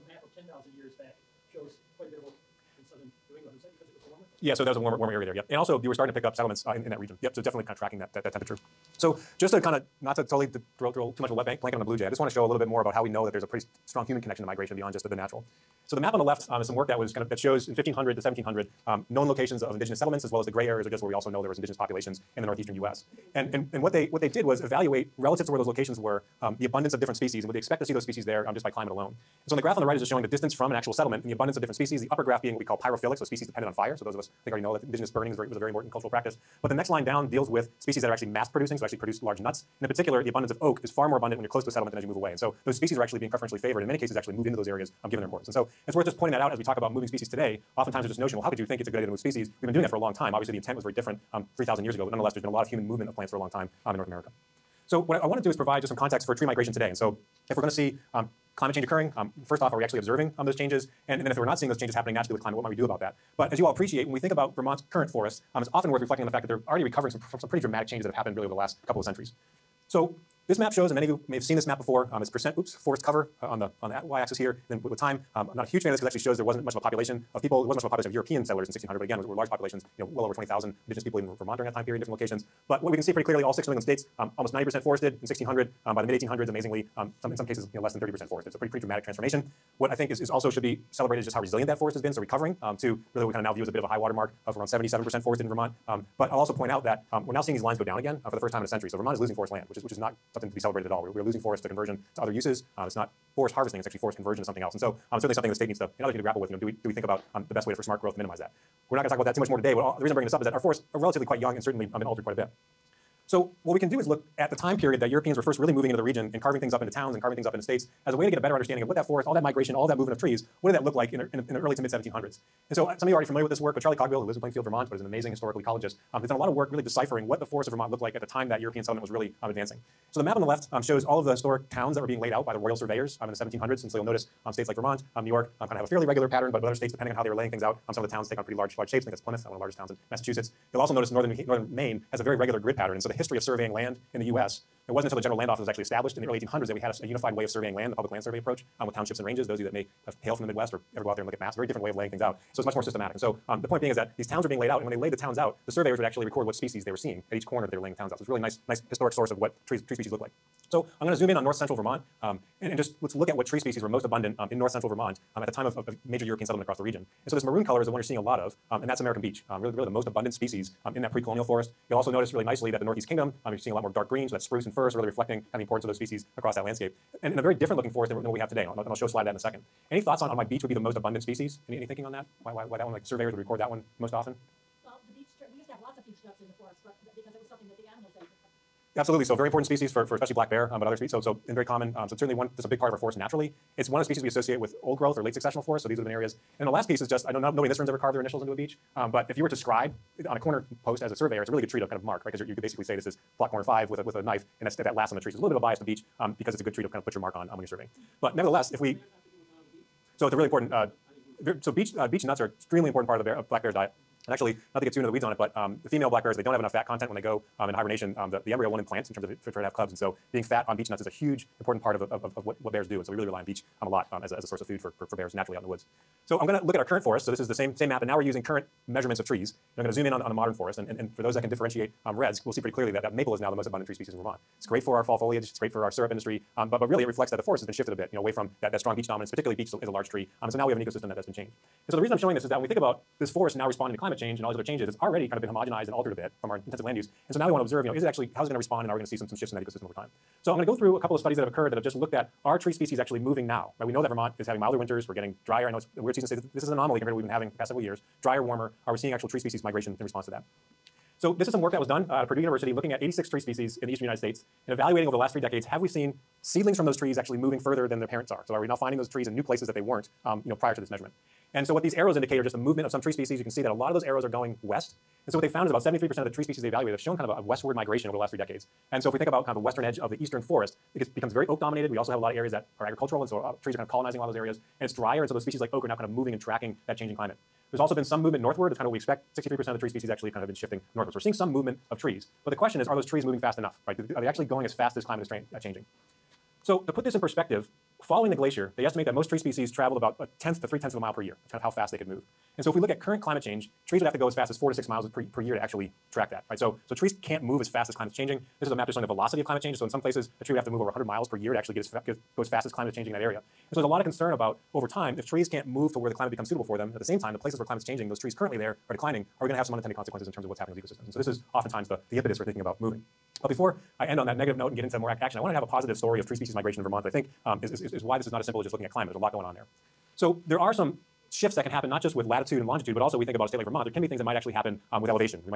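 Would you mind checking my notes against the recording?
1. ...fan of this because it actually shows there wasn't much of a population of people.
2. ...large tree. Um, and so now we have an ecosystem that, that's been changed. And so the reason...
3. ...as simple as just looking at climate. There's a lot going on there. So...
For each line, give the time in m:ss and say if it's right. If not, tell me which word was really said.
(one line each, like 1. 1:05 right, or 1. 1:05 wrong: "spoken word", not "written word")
1. 1:15 right
2. 3:59 right
3. 5:28 right.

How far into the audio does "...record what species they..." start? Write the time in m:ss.
2:36.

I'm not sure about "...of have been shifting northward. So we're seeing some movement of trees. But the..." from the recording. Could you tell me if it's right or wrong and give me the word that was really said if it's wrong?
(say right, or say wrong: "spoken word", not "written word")
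right.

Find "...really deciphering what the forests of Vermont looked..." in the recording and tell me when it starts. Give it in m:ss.
2:06.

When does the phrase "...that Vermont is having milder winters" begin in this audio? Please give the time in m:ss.
4:14.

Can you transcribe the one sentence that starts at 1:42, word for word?
Uh, it's not forest harvesting, it's actually forest conversion to something else.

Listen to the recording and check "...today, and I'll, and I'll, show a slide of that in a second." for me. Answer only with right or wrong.
right.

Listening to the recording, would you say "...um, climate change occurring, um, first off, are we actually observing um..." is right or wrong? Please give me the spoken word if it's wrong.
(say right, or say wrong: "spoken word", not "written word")
right.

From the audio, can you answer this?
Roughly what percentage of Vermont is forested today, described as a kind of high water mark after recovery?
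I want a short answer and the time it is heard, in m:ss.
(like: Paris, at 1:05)
77%, at 1:34.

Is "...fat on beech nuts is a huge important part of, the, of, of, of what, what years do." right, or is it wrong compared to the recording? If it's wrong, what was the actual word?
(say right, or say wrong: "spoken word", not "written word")
wrong: "bears", not "years".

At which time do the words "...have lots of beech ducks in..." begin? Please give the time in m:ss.
3:05.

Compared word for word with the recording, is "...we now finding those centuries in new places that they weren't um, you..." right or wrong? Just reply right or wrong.
wrong.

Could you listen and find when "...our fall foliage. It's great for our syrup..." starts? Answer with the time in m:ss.
3:54.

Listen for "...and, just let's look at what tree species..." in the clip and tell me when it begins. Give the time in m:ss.
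2:42.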